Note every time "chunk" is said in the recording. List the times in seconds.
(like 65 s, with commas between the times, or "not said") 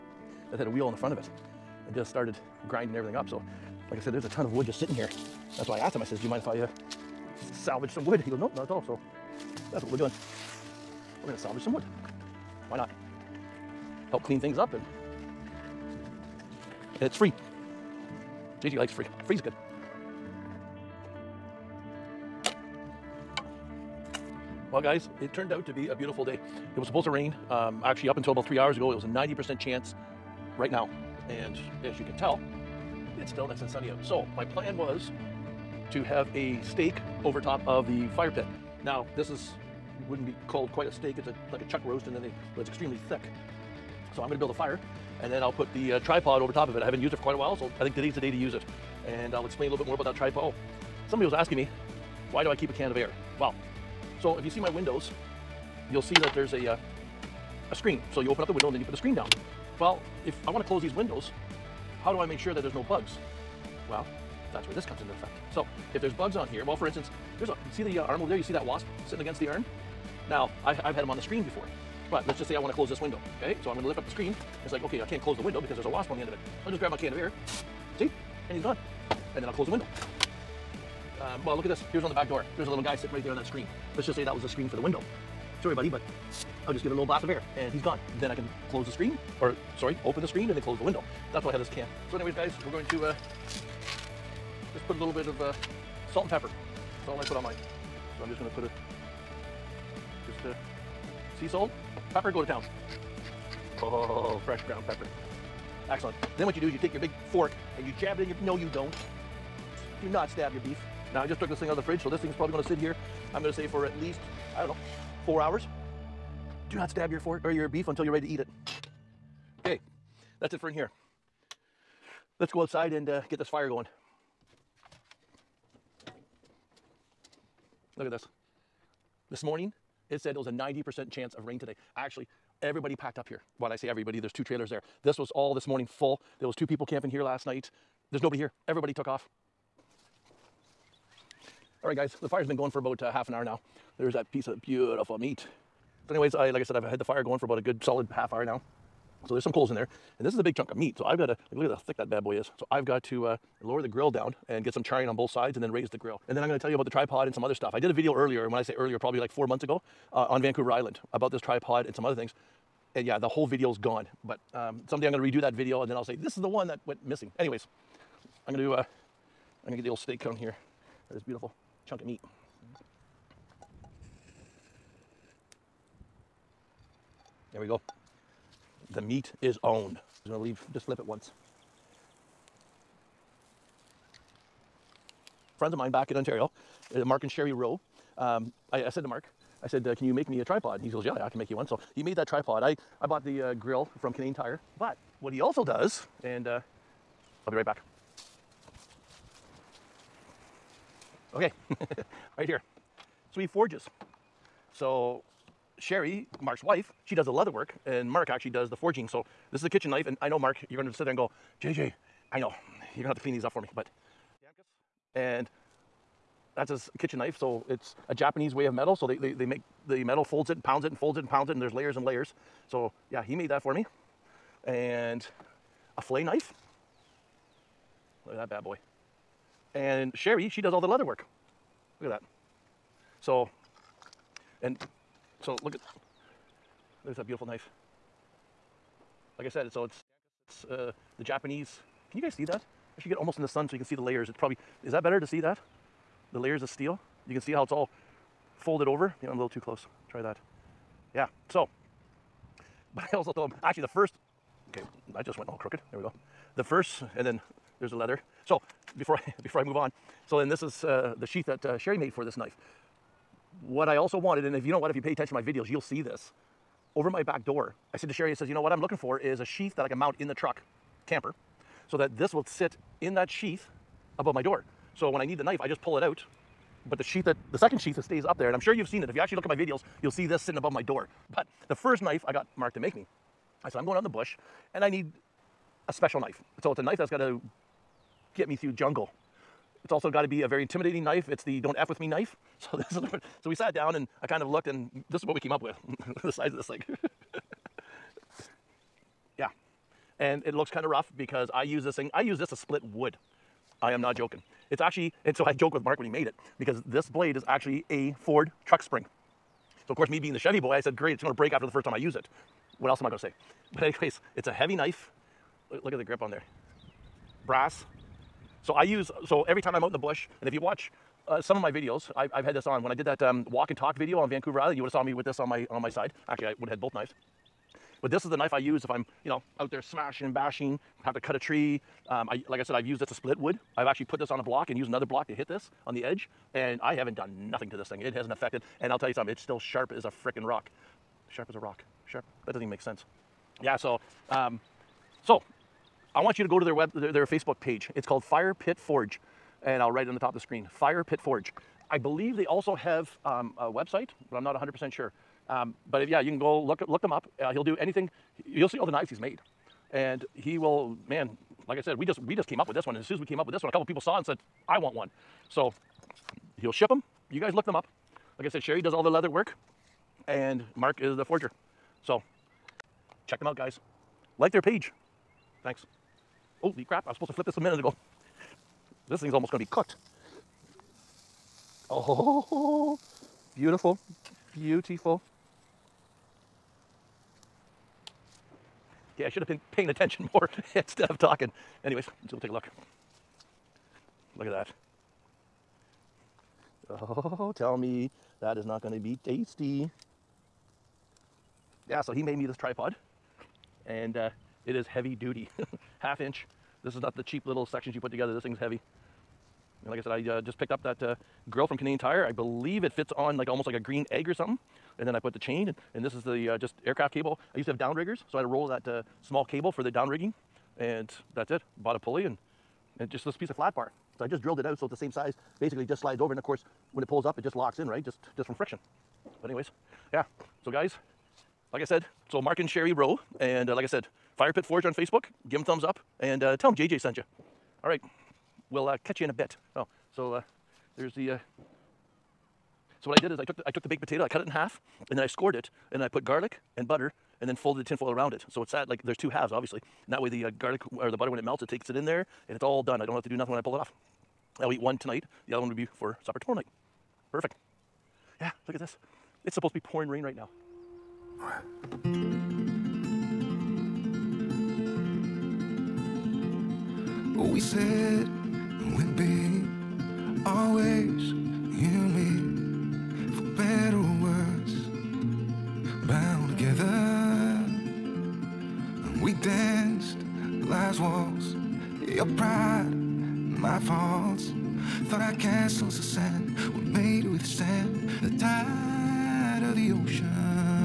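150 s, 171 s.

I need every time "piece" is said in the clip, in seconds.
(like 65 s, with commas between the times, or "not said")
144 s, 423 s.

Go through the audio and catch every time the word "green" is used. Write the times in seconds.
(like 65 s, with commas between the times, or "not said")
413 s.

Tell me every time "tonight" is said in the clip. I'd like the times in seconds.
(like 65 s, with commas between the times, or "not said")
454 s.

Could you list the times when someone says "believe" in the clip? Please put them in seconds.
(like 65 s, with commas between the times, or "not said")
351 s, 412 s.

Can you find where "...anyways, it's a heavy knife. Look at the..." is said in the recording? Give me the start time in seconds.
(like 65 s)
313 s.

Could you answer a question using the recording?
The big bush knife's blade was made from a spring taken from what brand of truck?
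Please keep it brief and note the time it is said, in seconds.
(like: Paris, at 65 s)
Ford, at 308 s.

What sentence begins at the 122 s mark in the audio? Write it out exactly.
Let's go outside and uh, get this fire going.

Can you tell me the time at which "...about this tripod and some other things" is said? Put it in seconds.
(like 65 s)
161 s.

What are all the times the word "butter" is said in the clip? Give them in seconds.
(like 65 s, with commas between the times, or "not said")
446 s, 451 s.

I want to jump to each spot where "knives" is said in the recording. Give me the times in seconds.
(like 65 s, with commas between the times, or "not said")
326 s, 358 s.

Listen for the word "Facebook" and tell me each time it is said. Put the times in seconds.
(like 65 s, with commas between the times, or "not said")
347 s, 434 s.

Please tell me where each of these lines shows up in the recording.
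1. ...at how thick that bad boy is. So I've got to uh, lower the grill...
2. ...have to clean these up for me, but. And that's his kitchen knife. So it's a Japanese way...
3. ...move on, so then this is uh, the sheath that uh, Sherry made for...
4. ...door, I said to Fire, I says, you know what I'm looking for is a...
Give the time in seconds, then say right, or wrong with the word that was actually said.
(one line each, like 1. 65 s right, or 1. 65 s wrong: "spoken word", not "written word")
1. 151 s right
2. 213 s right
3. 259 s right
4. 267 s wrong: "Sherry", not "Fire".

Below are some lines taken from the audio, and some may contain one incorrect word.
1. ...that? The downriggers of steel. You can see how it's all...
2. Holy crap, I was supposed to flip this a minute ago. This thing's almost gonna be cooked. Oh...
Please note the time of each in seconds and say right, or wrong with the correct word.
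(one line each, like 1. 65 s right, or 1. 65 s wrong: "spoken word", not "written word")
1. 245 s wrong: "layers", not "downriggers"
2. 376 s right.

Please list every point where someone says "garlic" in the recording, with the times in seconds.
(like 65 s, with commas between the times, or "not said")
446 s, 450 s.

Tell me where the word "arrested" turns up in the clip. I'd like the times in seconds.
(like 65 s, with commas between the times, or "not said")
not said.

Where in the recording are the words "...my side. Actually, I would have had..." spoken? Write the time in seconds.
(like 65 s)
325 s.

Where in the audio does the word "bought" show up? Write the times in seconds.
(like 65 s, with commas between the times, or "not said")
193 s, 421 s.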